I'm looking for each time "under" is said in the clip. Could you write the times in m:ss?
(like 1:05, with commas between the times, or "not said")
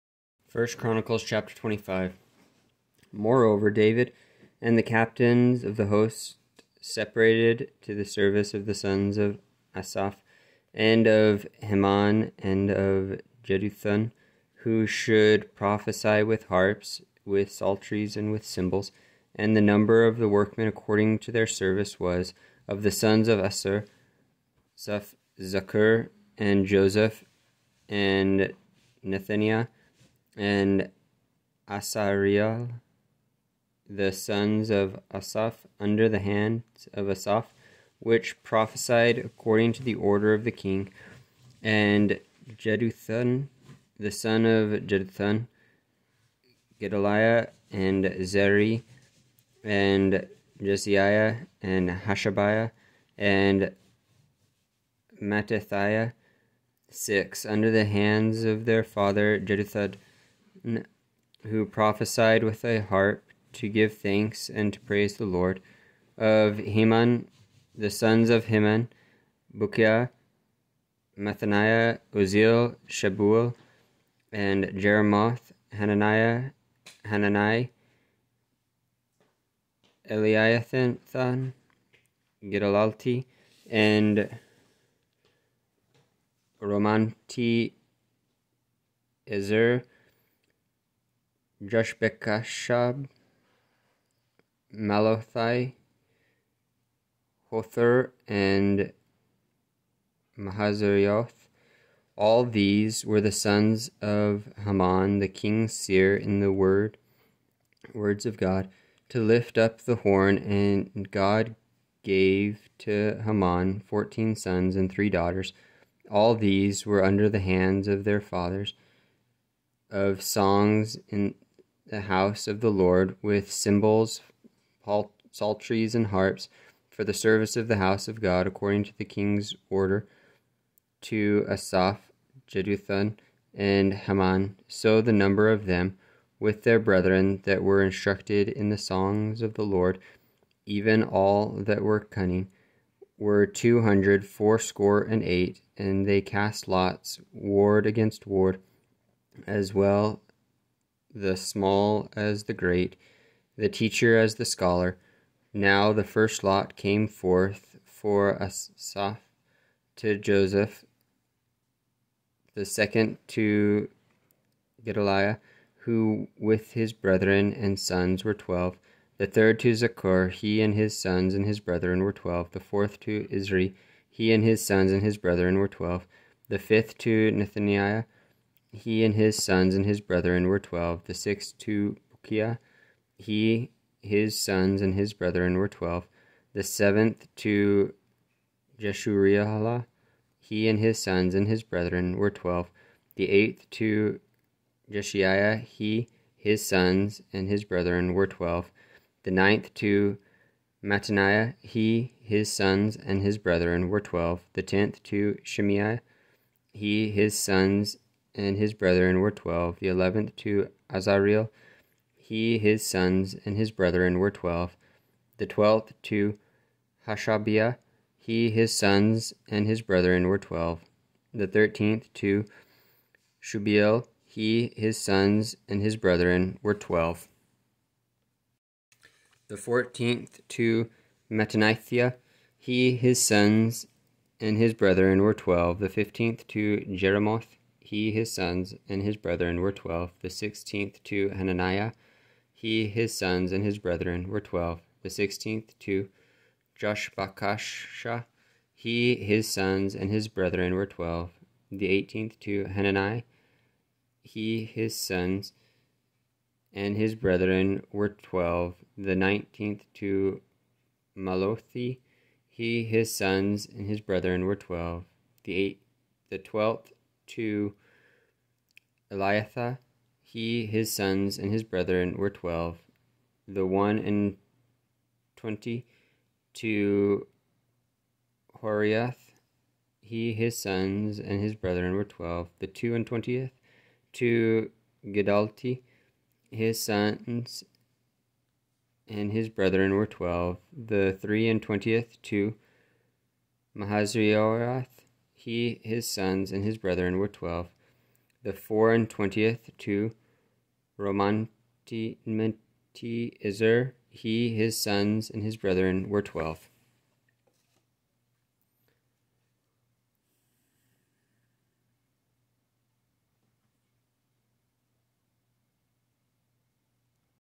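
0:35, 0:57, 1:57.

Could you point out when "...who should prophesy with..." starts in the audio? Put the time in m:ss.
0:14.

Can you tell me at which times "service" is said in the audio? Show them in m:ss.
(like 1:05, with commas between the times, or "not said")
0:08, 0:21, 2:07.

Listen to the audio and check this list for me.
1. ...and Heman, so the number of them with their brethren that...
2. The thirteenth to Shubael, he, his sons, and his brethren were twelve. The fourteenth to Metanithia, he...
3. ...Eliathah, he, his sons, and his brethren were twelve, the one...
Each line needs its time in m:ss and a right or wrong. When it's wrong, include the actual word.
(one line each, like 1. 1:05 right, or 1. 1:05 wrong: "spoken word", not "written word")
1. 2:13 right
2. 3:41 right
3. 4:29 right.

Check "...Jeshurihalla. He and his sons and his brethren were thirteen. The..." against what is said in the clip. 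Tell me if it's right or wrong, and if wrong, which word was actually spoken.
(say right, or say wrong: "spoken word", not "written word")
wrong: "twelve", not "thirteen".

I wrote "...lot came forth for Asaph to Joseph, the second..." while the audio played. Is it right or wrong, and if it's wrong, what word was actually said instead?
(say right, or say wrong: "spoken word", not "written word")
right.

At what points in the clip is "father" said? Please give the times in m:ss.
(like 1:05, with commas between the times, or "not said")
0:58, 1:58.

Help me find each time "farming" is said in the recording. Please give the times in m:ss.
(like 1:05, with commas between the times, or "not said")
not said.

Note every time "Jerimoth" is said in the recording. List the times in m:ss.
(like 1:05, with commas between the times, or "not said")
1:14.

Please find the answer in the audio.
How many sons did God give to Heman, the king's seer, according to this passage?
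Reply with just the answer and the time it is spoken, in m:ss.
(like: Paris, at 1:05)
14, at 1:53.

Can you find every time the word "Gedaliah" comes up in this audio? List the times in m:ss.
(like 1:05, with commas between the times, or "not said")
0:46, 2:44.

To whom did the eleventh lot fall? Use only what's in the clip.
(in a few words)
Azareel.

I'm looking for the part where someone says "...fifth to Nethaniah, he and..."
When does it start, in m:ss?
2:56.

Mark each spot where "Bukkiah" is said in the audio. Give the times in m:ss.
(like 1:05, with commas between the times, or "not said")
1:09, 3:02.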